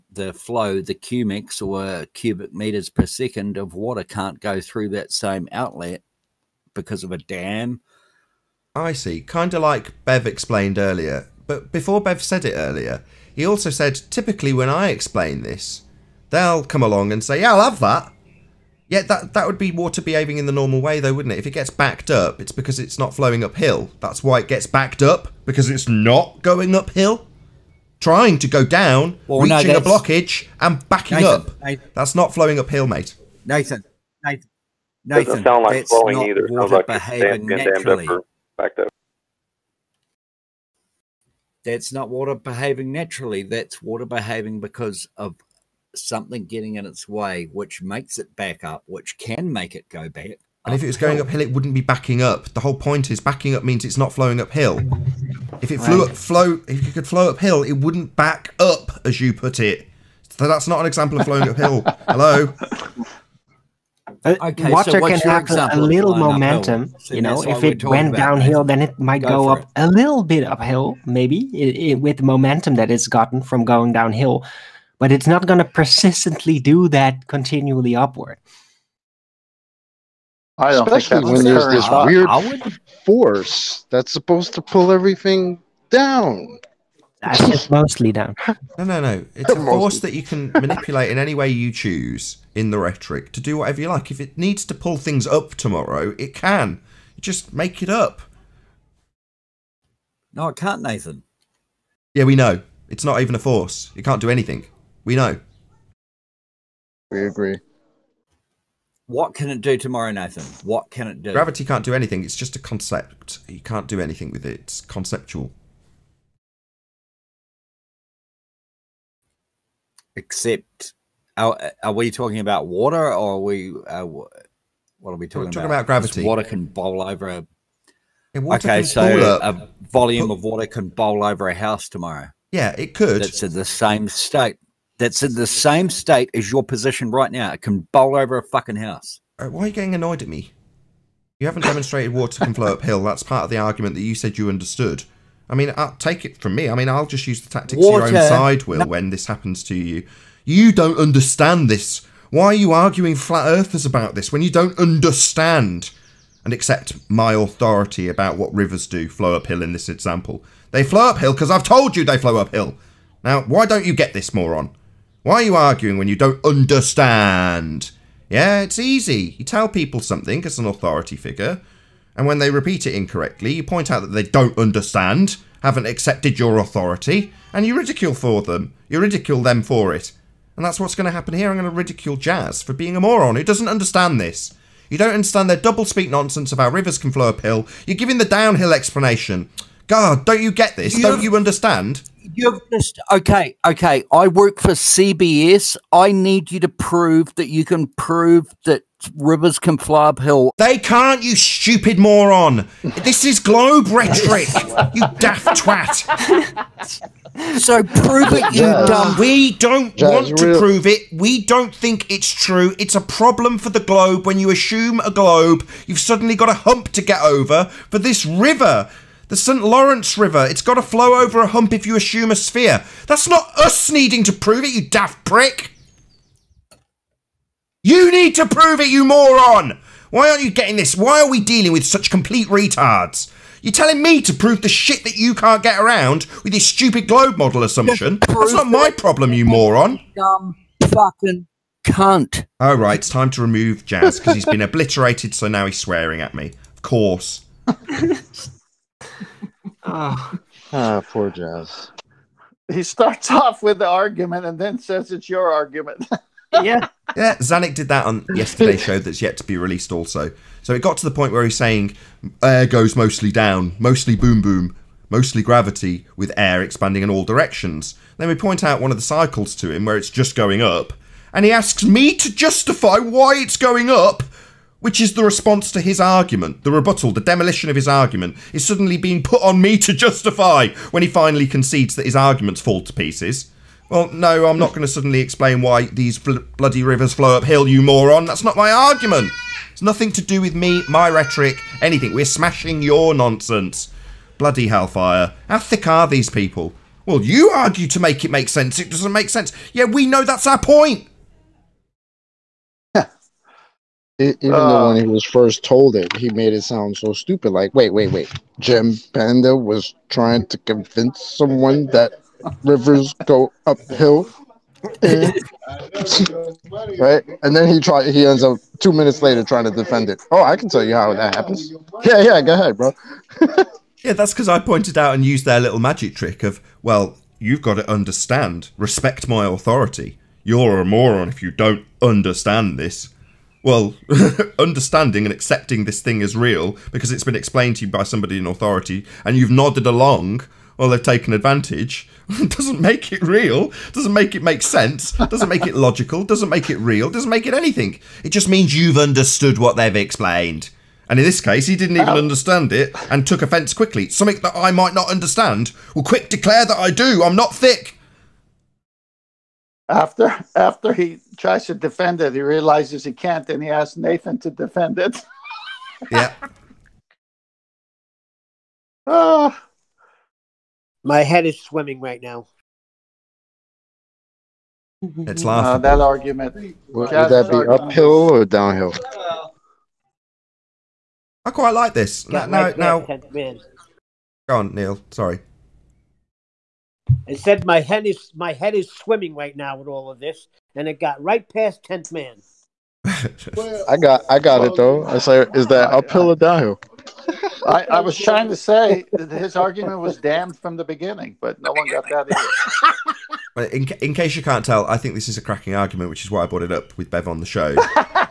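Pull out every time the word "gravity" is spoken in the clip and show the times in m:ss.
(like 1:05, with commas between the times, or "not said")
1:51, 2:05, 4:25.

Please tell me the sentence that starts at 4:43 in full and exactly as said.
Well, no, I'm not going to suddenly explain why these bl bloody rivers flow uphill, you moron.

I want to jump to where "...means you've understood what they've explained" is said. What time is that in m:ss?
5:48.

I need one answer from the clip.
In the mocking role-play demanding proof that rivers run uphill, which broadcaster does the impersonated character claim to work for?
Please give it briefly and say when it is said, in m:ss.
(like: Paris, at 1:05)
CBS, at 3:14.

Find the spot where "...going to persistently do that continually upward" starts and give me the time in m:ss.
1:15.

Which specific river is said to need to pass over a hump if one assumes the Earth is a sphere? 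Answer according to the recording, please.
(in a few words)
St. Lawrence River.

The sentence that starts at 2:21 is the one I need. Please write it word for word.
You haven't demonstrated water can flow uphill.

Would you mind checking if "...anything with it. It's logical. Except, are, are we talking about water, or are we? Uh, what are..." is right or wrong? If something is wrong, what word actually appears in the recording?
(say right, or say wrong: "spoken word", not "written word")
wrong: "conceptual", not "logical".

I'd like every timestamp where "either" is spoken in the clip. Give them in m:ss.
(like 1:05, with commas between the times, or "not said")
0:36, 6:43.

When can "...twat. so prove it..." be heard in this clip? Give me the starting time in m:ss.
3:25.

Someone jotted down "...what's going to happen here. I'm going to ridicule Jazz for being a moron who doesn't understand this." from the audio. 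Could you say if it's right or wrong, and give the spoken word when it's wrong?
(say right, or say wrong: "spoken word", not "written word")
right.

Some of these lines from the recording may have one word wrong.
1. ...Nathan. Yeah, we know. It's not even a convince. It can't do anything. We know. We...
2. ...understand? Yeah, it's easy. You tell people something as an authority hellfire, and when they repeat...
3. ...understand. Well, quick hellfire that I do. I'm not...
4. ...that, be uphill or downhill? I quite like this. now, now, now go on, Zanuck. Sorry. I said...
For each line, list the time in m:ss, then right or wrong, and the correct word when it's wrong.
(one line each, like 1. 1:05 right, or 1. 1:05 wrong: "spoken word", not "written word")
1. 1:40 wrong: "force", not "convince"
2. 2:46 wrong: "figure", not "hellfire"
3. 5:55 wrong: "declare", not "hellfire"
4. 6:17 wrong: "Neil", not "Zanuck".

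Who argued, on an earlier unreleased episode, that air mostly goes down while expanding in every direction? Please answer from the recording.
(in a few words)
Zanuck.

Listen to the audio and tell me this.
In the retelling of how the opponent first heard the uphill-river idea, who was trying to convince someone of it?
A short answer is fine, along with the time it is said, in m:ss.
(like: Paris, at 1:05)
Jim Panda, at 5:08.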